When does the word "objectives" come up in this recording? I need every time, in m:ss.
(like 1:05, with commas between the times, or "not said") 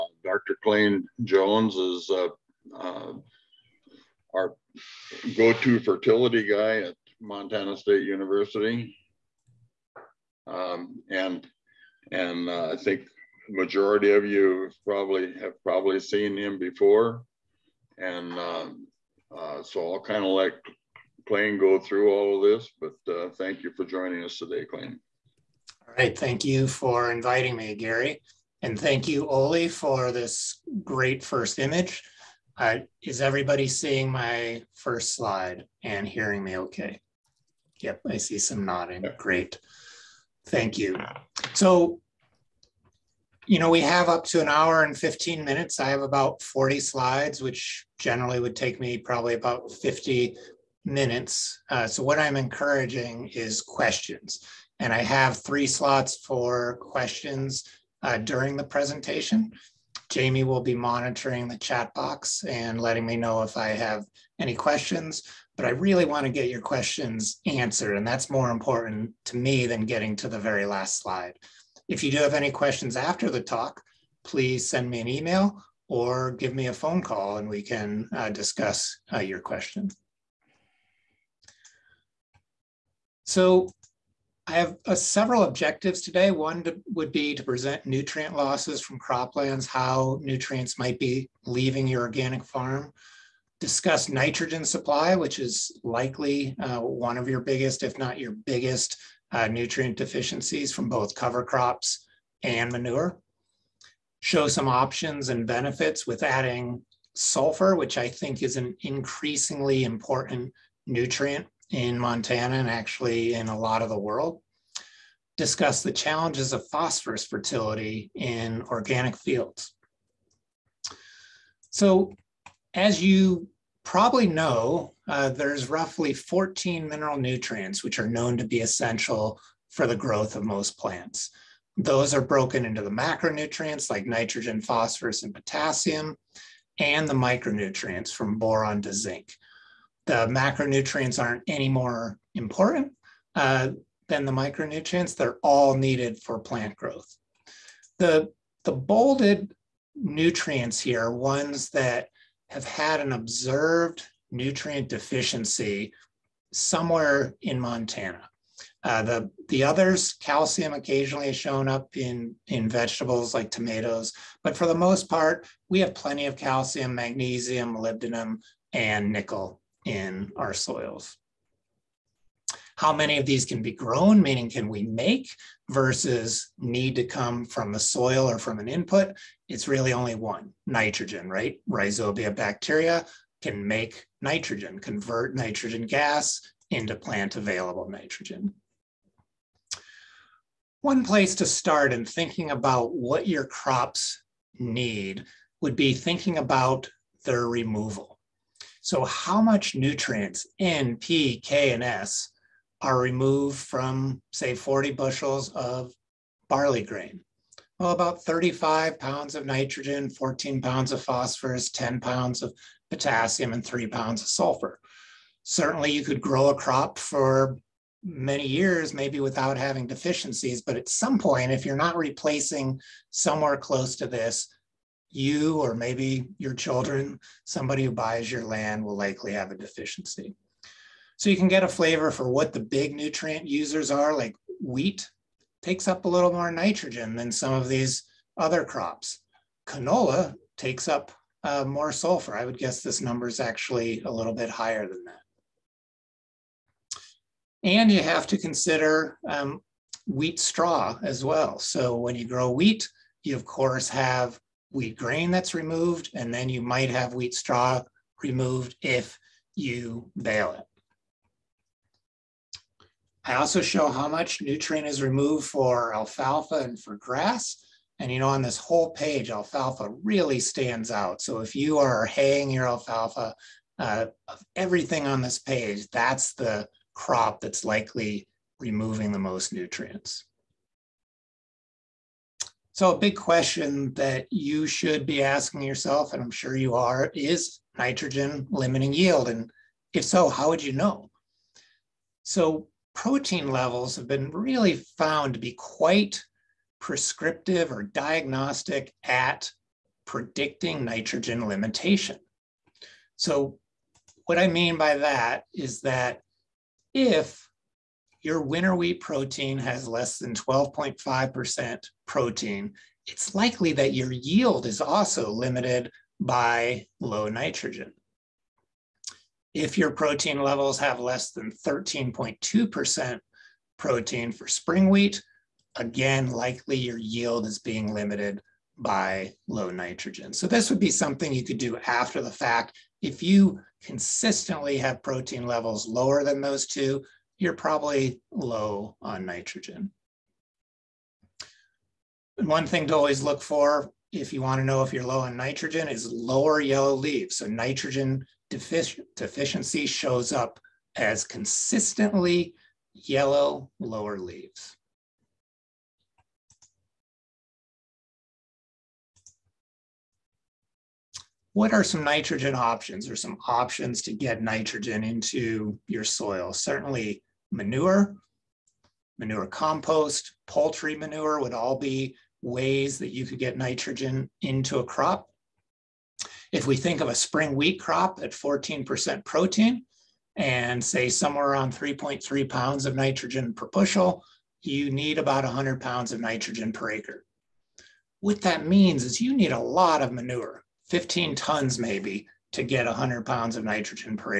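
1:25.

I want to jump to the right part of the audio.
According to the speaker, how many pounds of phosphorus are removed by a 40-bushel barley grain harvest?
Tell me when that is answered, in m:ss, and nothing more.
3:30.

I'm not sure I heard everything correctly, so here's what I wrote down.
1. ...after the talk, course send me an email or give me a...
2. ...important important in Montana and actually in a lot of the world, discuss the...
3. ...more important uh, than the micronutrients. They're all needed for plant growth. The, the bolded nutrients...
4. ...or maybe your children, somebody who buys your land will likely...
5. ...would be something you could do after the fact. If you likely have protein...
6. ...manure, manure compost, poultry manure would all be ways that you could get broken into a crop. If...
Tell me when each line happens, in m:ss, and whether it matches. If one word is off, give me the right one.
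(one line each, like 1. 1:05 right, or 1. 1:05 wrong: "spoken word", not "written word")
1. 1:12 wrong: "please", not "course"
2. 1:49 wrong: "nutrient", not "important"
3. 2:21 right
4. 3:45 right
5. 5:30 wrong: "consistently", not "likely"
6. 6:07 wrong: "nitrogen", not "broken".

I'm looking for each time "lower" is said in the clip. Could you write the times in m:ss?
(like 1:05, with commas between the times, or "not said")
5:35, 5:46, 5:53.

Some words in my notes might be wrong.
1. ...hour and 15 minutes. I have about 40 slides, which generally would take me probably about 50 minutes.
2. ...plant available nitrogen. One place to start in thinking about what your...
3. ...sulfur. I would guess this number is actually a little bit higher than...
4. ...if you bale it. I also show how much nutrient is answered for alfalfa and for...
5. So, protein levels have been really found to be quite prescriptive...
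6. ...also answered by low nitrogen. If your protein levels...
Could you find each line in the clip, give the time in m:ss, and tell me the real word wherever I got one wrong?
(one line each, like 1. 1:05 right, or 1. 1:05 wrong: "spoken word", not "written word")
1. 0:44 right
2. 3:06 right
3. 4:01 right
4. 4:18 wrong: "removed", not "answered"
5. 4:52 right
6. 5:14 wrong: "limited", not "answered".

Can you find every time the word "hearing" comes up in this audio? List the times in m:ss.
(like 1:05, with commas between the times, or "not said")
0:36.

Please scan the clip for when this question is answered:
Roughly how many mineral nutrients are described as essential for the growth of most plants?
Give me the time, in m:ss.
2:05.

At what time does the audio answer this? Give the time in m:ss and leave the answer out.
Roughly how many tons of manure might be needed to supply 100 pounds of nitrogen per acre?
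6:30.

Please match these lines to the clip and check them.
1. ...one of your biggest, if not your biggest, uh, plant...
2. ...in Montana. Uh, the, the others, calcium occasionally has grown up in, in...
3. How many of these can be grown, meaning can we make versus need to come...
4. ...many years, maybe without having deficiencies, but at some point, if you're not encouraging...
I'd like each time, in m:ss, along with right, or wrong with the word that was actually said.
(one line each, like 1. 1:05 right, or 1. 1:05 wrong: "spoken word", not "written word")
1. 1:36 wrong: "nutrient", not "plant"
2. 2:37 wrong: "shown", not "grown"
3. 2:52 right
4. 3:38 wrong: "replacing", not "encouraging".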